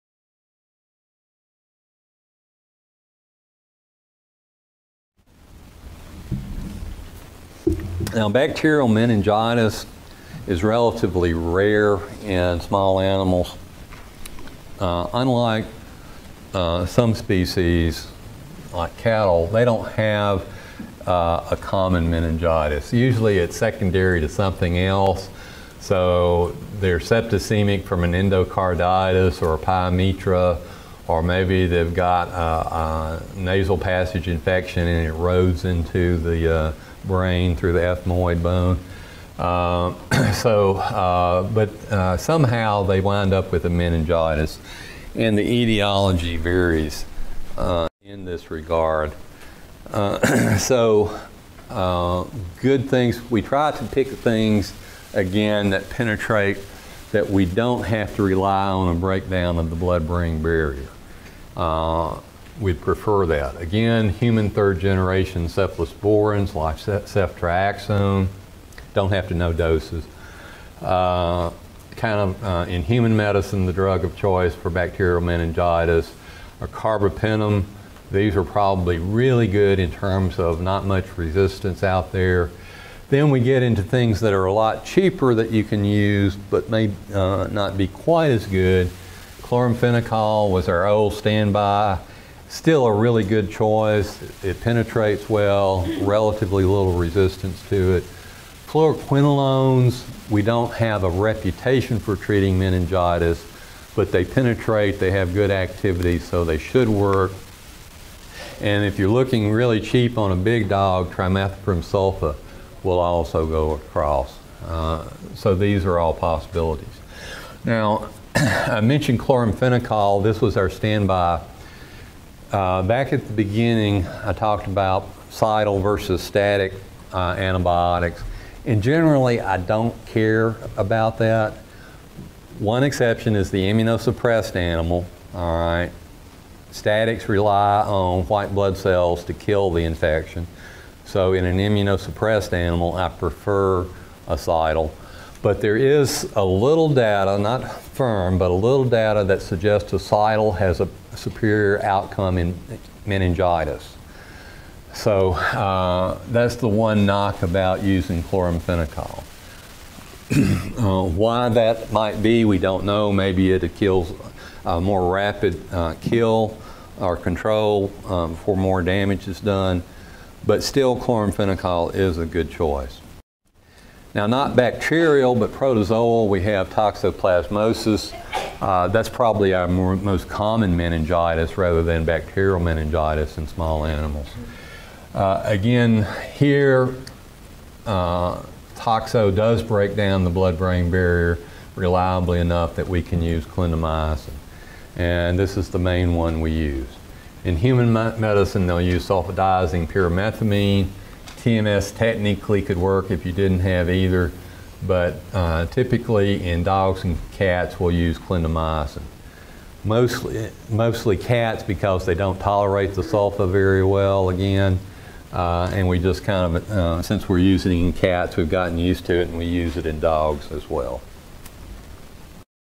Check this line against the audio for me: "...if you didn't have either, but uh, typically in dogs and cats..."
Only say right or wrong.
right.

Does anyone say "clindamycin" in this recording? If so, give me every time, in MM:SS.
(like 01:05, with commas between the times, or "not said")
03:13, 03:28.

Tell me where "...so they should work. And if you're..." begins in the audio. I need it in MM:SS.
01:46.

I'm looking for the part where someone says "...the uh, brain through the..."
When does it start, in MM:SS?
00:36.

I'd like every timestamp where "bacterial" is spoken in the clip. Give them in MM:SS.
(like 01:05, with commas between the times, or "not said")
00:08, 01:14, 02:54, 03:02.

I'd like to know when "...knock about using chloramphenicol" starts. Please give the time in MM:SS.
02:37.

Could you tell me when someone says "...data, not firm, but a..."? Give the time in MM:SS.
02:26.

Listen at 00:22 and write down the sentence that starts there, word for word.
Usually it's secondary to something else.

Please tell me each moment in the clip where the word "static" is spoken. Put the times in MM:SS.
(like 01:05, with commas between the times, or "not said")
02:06, 02:16.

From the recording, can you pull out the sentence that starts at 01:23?
Then we get into things that are a lot cheaper that you can use but may uh, not be quite as good.